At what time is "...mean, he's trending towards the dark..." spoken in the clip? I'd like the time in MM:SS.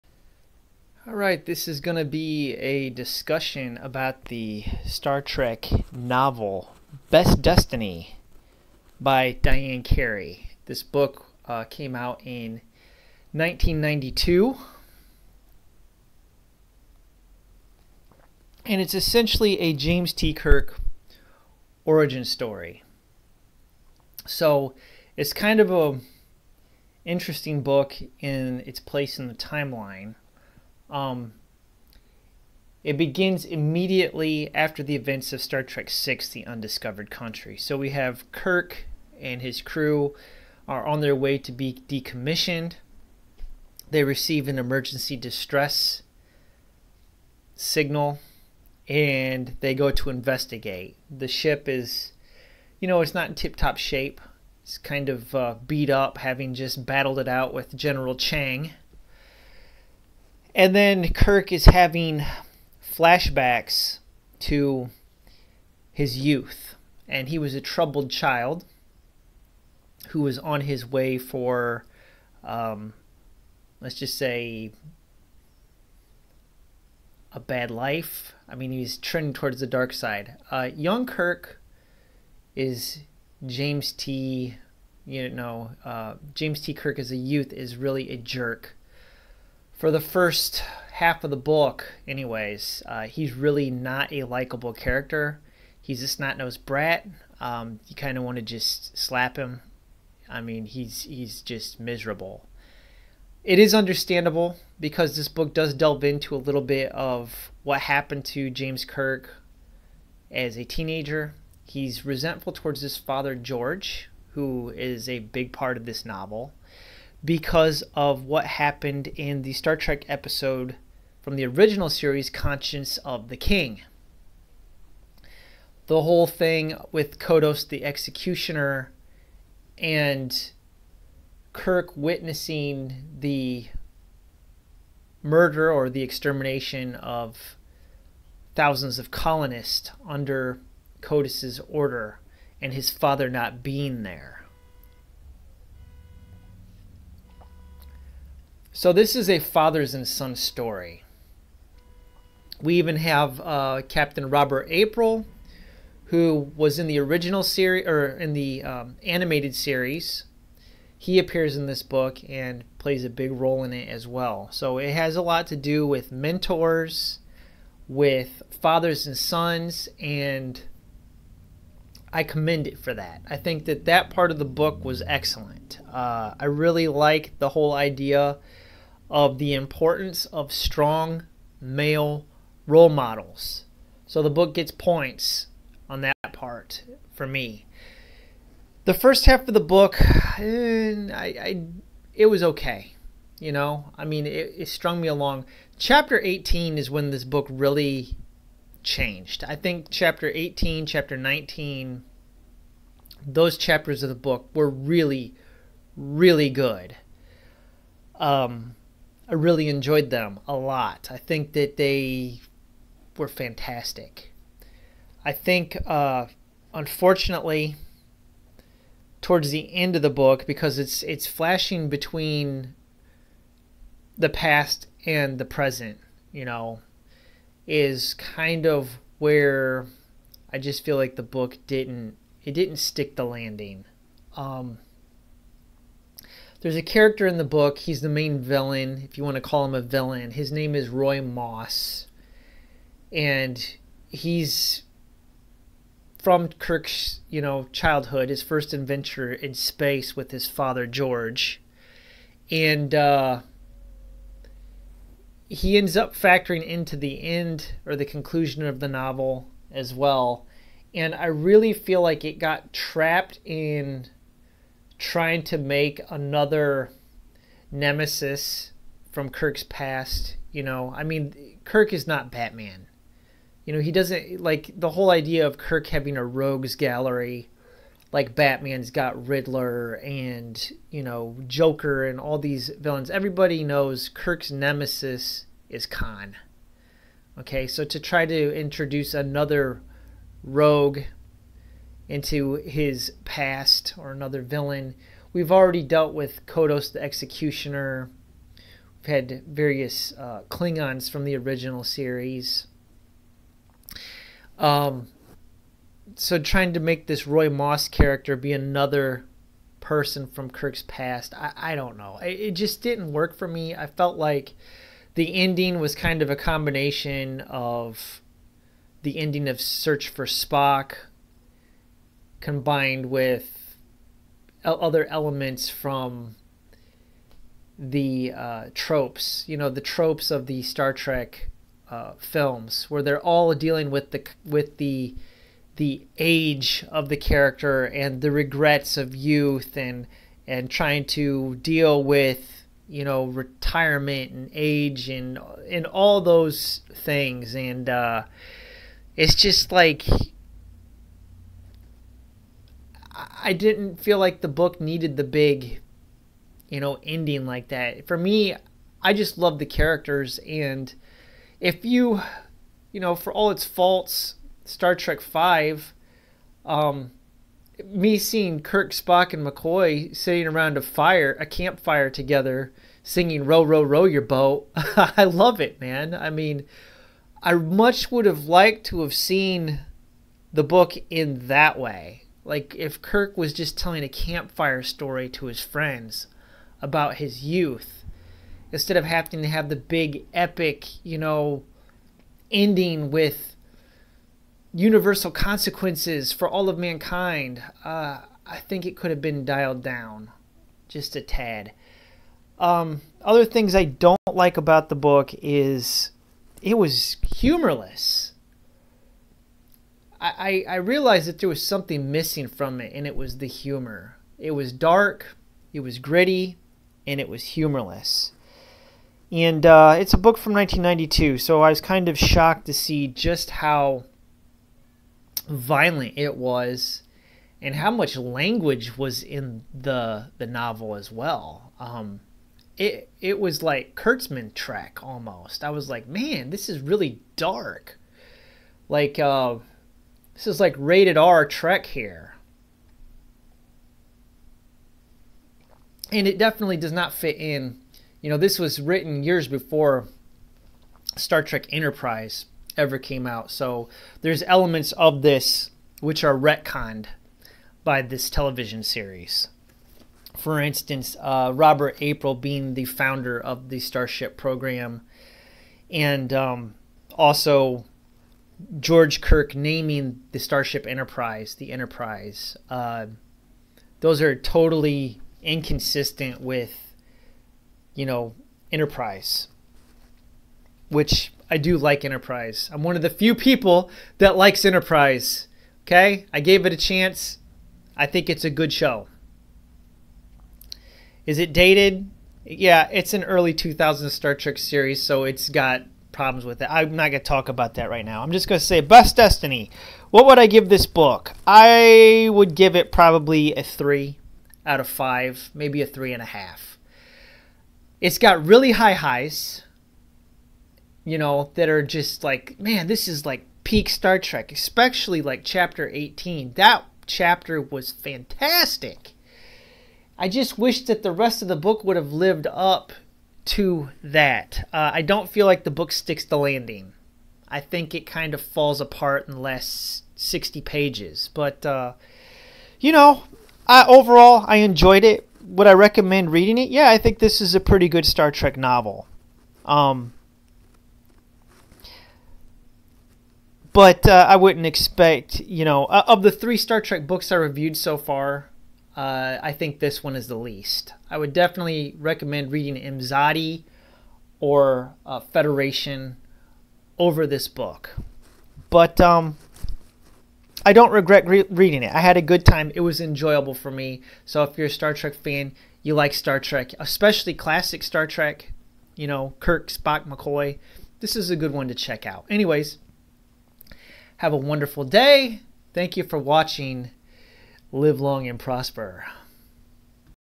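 01:18.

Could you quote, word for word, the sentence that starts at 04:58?
We've had various uh, Klingons from the original series.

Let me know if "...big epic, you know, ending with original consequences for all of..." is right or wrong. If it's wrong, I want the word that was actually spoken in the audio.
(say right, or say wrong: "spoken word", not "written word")
wrong: "universal", not "original".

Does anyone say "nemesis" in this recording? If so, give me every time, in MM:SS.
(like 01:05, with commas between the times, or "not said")
04:27, 04:44.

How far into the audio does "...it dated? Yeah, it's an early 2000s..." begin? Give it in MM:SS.
08:11.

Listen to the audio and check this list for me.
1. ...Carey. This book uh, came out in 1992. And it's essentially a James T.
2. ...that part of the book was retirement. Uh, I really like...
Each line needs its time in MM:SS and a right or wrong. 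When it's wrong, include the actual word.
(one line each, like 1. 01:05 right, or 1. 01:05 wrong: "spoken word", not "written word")
1. 00:09 right
2. 02:53 wrong: "excellent", not "retirement".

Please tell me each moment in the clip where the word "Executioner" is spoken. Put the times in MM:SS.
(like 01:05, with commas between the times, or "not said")
02:07, 04:57.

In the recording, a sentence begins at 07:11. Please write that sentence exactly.
Um, it, it was like Kurtzman Trek almost.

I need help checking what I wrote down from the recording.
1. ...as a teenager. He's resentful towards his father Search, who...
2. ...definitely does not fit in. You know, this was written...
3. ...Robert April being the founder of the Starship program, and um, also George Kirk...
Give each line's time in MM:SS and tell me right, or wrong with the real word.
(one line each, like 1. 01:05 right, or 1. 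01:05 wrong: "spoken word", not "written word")
1. 01:50 wrong: "George", not "Search"
2. 07:26 right
3. 07:41 right.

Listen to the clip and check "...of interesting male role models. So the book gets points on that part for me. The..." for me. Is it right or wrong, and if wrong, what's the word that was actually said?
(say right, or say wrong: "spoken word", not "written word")
wrong: "strong", not "interesting".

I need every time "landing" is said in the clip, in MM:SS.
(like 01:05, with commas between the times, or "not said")
03:53, 08:46.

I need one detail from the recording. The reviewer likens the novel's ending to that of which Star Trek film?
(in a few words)
Search for Spock.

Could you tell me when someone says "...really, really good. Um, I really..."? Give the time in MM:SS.
03:24.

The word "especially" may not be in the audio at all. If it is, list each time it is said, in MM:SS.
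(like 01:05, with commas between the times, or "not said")
08:34, 09:26.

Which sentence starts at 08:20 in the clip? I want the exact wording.
What would I give this book?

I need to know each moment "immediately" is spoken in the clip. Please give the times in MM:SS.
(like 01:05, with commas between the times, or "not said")
00:33.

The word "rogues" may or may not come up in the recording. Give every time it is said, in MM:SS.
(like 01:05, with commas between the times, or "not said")
04:36, 04:50.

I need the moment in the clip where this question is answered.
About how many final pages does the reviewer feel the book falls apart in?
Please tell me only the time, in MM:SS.
08:50.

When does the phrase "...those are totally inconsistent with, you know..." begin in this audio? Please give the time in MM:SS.
07:53.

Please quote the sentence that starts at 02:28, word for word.
So this is a fathers and son story.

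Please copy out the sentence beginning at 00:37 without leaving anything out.
So we have Kirk and his crew are on their way to be decommissioned.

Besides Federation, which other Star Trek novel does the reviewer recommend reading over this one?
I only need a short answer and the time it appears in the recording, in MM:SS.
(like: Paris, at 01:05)
Imzadi, at 09:12.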